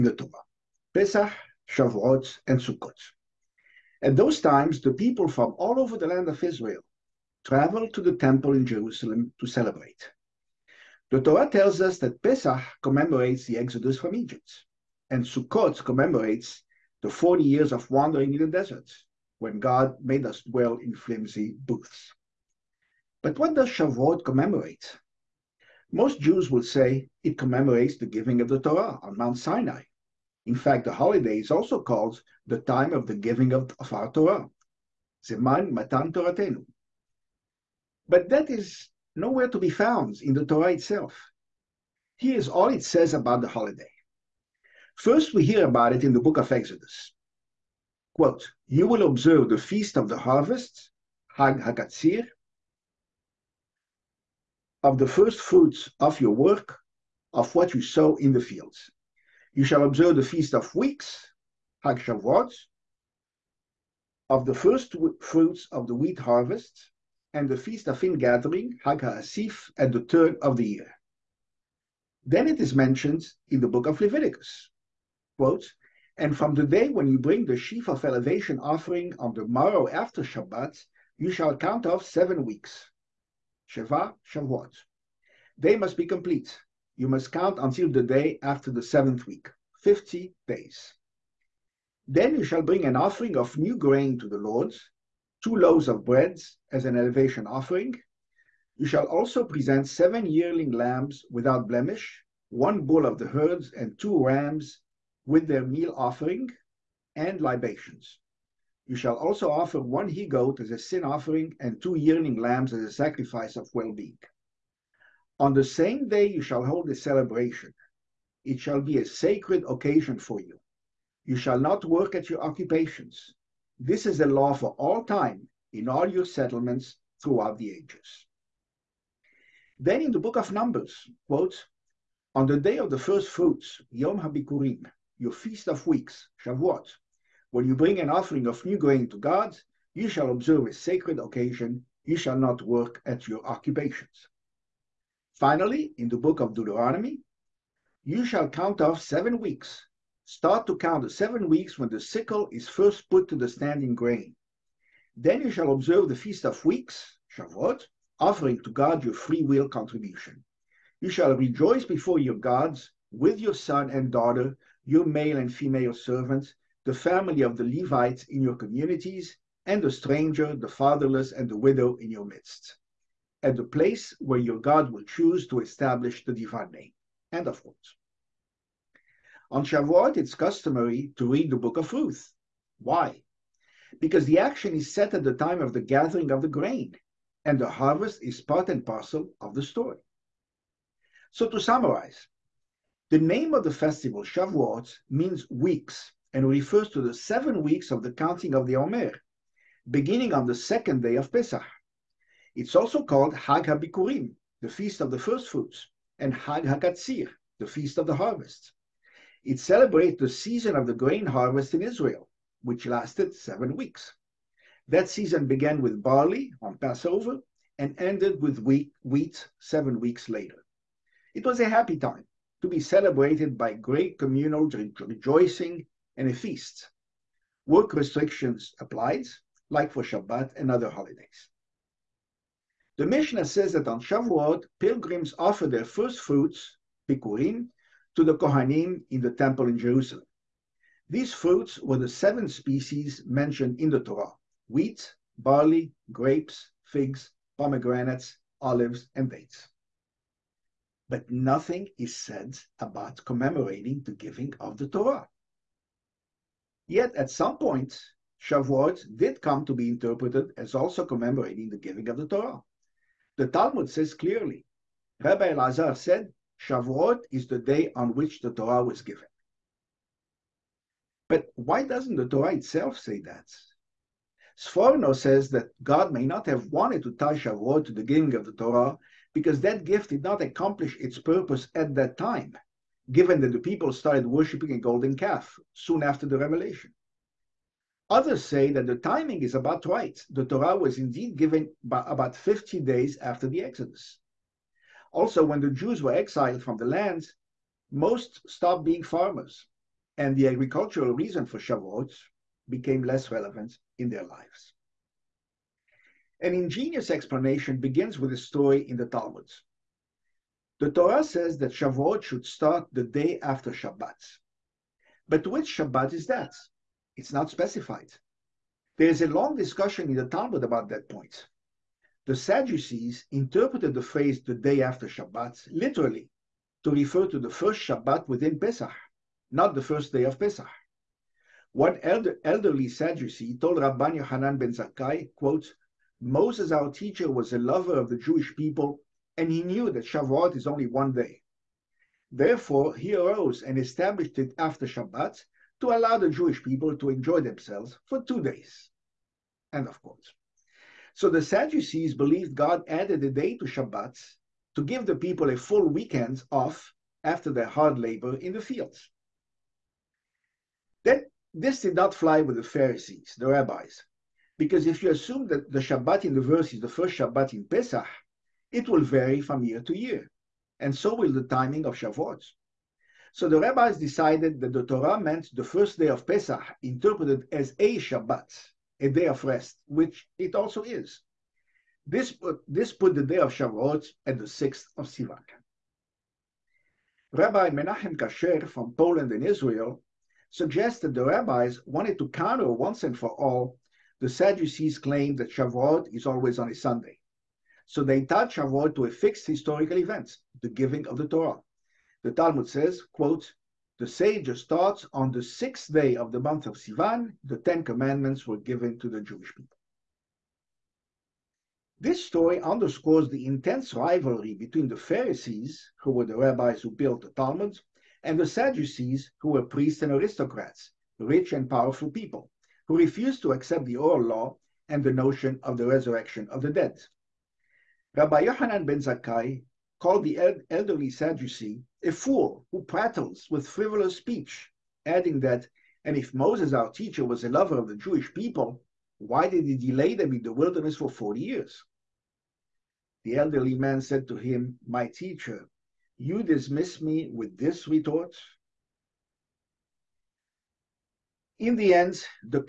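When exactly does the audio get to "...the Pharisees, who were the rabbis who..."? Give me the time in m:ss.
6:54.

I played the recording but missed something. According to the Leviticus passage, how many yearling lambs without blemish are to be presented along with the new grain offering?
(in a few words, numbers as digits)
7.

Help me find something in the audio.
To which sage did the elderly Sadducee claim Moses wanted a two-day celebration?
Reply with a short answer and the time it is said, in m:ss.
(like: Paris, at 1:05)
Rabban Yohanan ben Zakkai, at 5:33.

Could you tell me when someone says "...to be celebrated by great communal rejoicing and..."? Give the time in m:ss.
3:42.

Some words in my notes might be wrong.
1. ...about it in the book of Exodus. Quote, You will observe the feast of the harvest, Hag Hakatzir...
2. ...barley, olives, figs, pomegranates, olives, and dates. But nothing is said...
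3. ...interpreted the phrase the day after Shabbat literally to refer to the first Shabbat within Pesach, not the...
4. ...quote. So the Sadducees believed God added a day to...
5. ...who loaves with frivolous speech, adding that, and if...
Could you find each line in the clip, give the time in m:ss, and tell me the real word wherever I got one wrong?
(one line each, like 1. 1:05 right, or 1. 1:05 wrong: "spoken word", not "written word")
1. 0:45 right
2. 4:05 wrong: "grapes", not "olives"
3. 5:23 right
4. 5:50 right
5. 7:12 wrong: "prattles", not "loaves".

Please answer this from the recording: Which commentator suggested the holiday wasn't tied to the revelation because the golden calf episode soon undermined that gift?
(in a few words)
Sforno.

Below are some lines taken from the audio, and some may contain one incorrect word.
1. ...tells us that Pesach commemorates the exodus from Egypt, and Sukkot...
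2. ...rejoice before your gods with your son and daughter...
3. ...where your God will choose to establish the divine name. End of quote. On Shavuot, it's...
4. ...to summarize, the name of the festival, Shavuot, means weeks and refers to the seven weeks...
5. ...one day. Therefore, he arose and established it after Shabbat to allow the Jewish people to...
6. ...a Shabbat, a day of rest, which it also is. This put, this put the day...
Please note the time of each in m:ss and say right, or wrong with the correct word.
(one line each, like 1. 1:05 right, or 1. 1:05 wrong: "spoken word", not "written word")
1. 0:11 right
2. 2:41 right
3. 2:54 right
4. 3:11 right
5. 5:40 right
6. 6:17 right.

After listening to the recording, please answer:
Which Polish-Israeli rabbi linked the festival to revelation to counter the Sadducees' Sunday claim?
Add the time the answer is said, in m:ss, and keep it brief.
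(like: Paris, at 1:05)
Menachem Kasher, at 6:27.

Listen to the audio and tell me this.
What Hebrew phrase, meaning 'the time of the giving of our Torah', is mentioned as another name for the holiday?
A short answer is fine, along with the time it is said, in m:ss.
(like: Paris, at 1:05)
Zeman Matan Toratenu, at 0:35.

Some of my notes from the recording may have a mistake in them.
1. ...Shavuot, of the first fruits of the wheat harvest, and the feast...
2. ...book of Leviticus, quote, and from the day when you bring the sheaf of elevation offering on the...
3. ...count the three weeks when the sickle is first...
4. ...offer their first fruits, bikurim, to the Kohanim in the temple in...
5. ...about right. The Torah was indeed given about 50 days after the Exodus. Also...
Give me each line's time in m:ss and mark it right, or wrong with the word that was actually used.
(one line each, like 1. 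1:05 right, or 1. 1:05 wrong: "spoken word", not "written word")
1. 1:01 right
2. 1:13 right
3. 2:30 wrong: "seven", not "three"
4. 3:55 right
5. 4:49 right.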